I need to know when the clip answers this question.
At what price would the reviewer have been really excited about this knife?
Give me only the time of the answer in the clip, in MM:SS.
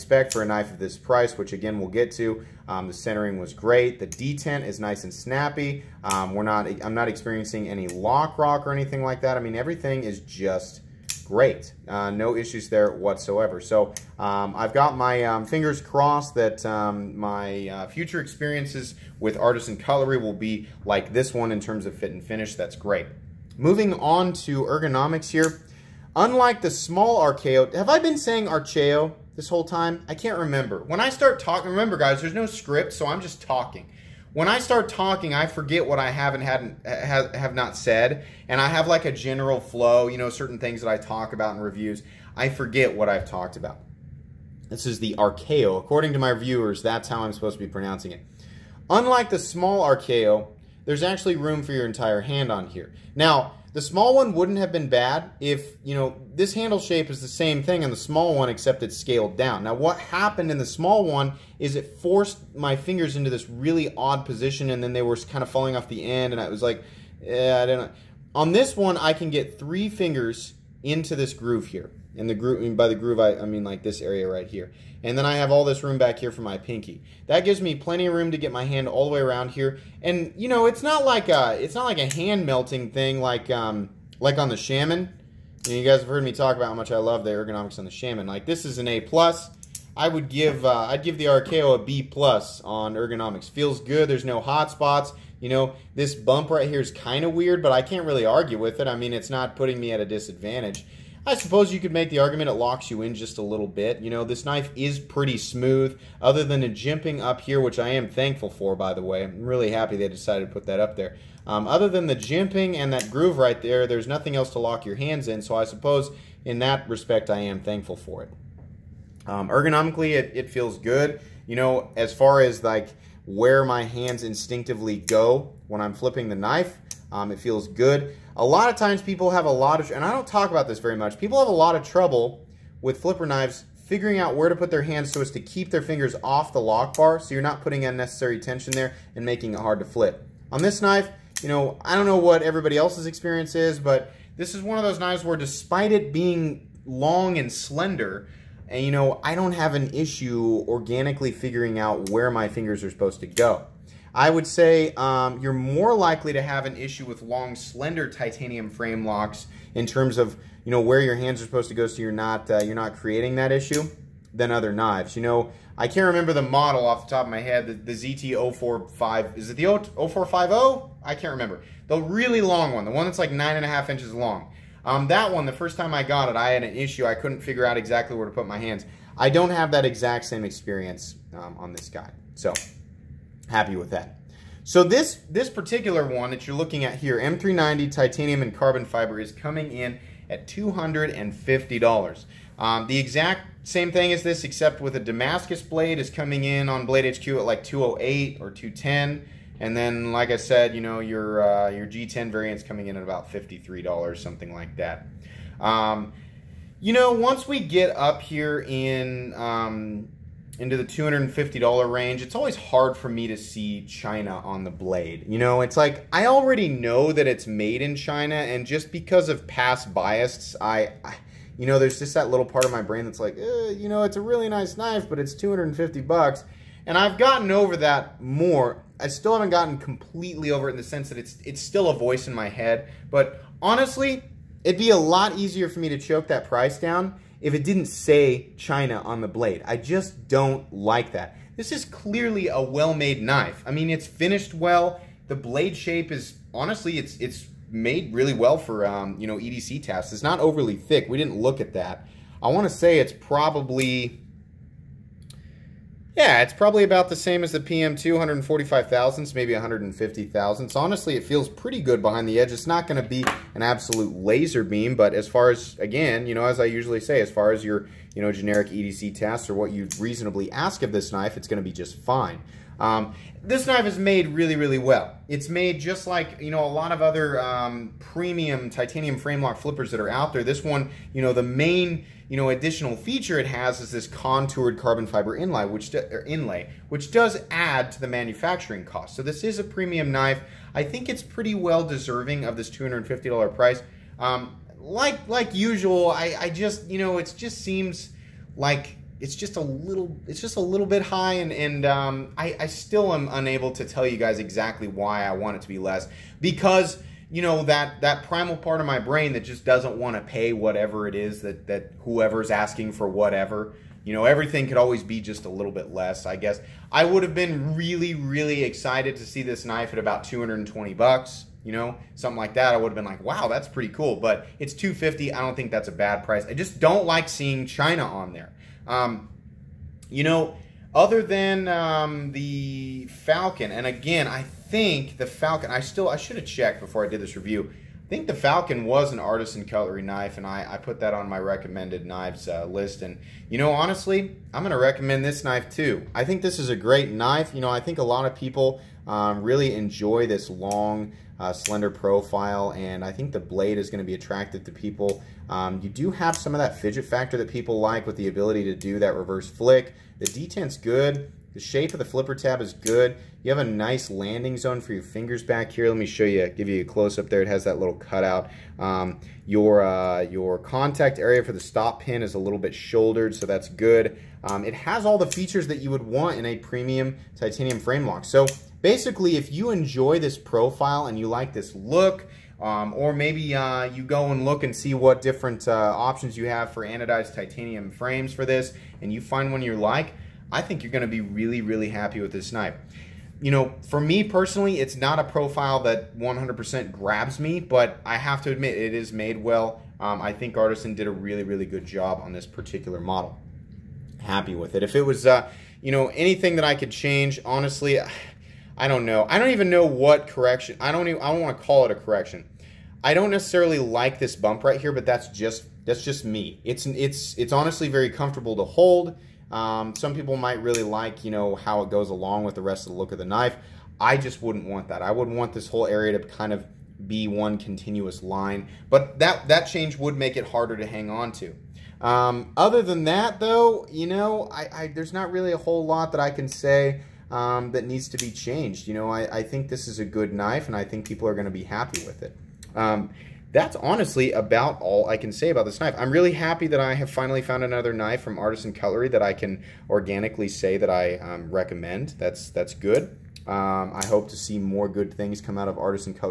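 05:20.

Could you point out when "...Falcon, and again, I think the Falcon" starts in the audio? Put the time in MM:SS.
05:33.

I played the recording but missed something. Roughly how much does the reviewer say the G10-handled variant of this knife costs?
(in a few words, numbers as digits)
$53.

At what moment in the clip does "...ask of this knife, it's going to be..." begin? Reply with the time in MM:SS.
04:30.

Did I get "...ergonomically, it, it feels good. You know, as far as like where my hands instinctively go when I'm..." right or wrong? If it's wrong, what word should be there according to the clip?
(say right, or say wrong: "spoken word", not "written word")
right.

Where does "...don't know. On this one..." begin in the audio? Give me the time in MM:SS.
01:07.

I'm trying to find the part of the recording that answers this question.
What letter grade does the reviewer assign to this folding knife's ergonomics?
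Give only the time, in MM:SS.
01:31.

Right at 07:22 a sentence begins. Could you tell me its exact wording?
Um, that's honestly about all I can say about this knife.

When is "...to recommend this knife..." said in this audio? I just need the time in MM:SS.
05:44.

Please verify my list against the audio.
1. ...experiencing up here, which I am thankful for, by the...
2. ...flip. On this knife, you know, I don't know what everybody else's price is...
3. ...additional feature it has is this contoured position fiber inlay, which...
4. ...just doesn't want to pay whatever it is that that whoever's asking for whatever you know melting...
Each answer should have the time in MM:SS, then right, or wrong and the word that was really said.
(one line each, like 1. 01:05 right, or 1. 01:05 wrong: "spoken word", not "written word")
1. 01:46 wrong: "jimping", not "experiencing"
2. 02:19 wrong: "experience", not "price"
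3. 04:42 wrong: "carbon", not "position"
4. 05:09 wrong: "everything", not "melting".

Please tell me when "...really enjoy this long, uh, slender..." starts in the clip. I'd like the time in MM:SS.
05:49.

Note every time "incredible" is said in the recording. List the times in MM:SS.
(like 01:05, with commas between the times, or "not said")
not said.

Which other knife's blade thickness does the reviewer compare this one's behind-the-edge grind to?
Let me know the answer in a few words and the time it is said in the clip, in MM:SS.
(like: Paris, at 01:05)
PM2, at 04:17.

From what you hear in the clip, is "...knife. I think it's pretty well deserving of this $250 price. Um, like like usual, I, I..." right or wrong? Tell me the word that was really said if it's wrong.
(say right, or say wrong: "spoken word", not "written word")
right.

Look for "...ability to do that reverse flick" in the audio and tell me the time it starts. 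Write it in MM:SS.
05:58.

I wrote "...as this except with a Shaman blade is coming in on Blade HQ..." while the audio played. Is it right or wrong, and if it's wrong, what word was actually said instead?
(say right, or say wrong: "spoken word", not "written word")
wrong: "Damascus", not "Shaman".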